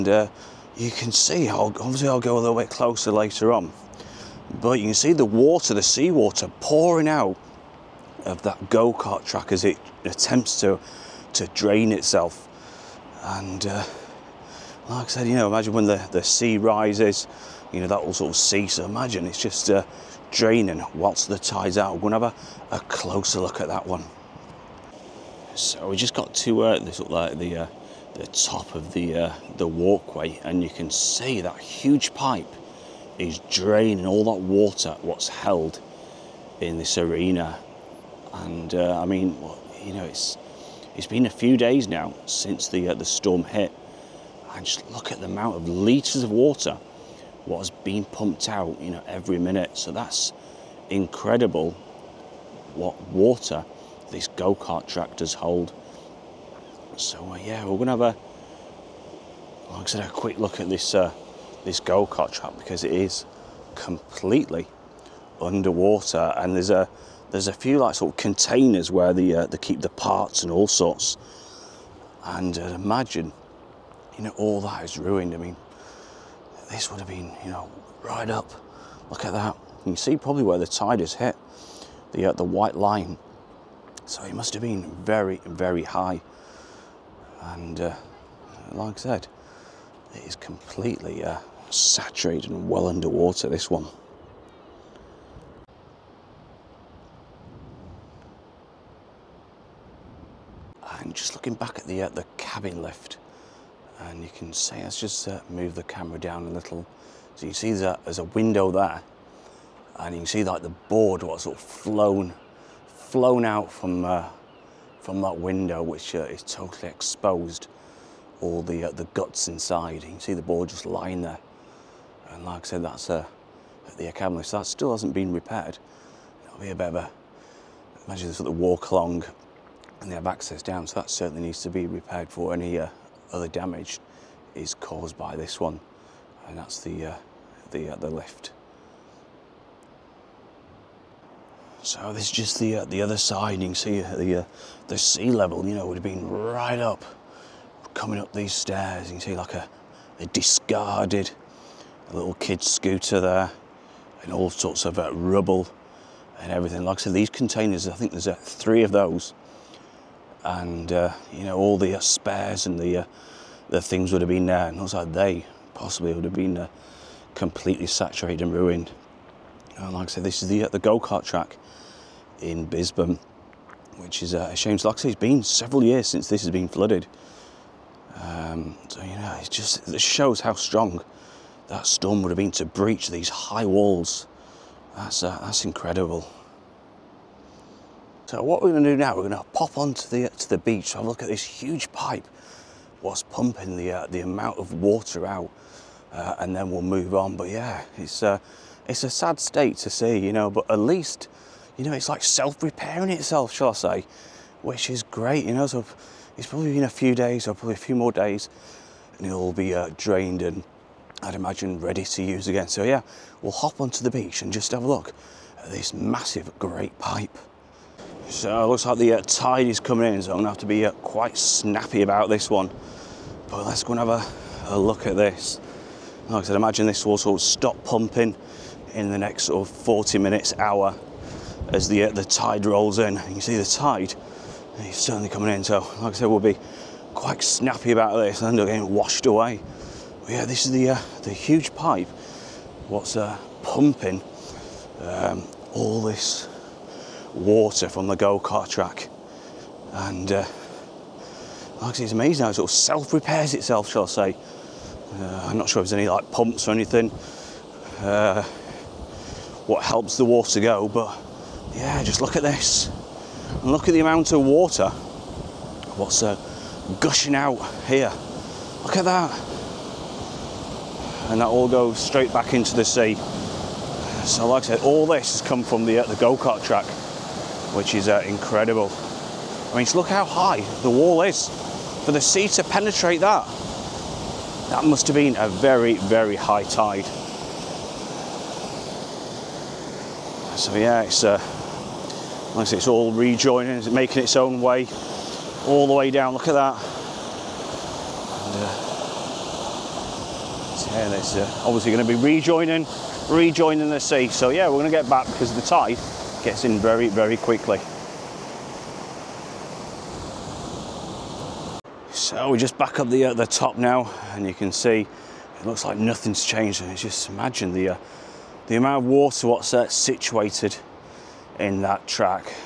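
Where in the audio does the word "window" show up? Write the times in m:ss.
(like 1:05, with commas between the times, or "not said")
1:48, 1:55.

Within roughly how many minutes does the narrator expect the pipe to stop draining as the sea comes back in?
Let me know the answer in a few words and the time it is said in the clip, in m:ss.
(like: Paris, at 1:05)
40, at 3:49.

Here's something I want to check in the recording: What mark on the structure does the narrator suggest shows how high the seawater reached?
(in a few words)
The white line.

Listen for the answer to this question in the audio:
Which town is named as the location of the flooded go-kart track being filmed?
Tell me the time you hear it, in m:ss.
2:52.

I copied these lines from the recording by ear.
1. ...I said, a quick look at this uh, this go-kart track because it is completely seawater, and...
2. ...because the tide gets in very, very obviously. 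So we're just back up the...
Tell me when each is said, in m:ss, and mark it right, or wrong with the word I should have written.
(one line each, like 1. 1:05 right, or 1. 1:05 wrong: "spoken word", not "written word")
1. 0:59 wrong: "underwater", not "seawater"
2. 5:05 wrong: "quickly", not "obviously".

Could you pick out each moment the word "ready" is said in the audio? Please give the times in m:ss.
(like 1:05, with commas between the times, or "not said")
3:31.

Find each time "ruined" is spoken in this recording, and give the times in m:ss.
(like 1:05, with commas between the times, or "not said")
1:14, 2:48.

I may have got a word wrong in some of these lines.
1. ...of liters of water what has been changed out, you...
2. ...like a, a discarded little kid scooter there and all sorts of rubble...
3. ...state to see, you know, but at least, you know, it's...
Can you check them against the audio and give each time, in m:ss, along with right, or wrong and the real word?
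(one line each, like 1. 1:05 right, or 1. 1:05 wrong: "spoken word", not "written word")
1. 0:45 wrong: "pumped", not "changed"
2. 2:29 right
3. 3:19 right.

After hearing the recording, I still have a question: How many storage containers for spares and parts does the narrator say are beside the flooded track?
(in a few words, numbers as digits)
3.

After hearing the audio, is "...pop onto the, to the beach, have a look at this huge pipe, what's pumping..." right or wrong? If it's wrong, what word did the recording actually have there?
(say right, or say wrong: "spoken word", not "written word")
right.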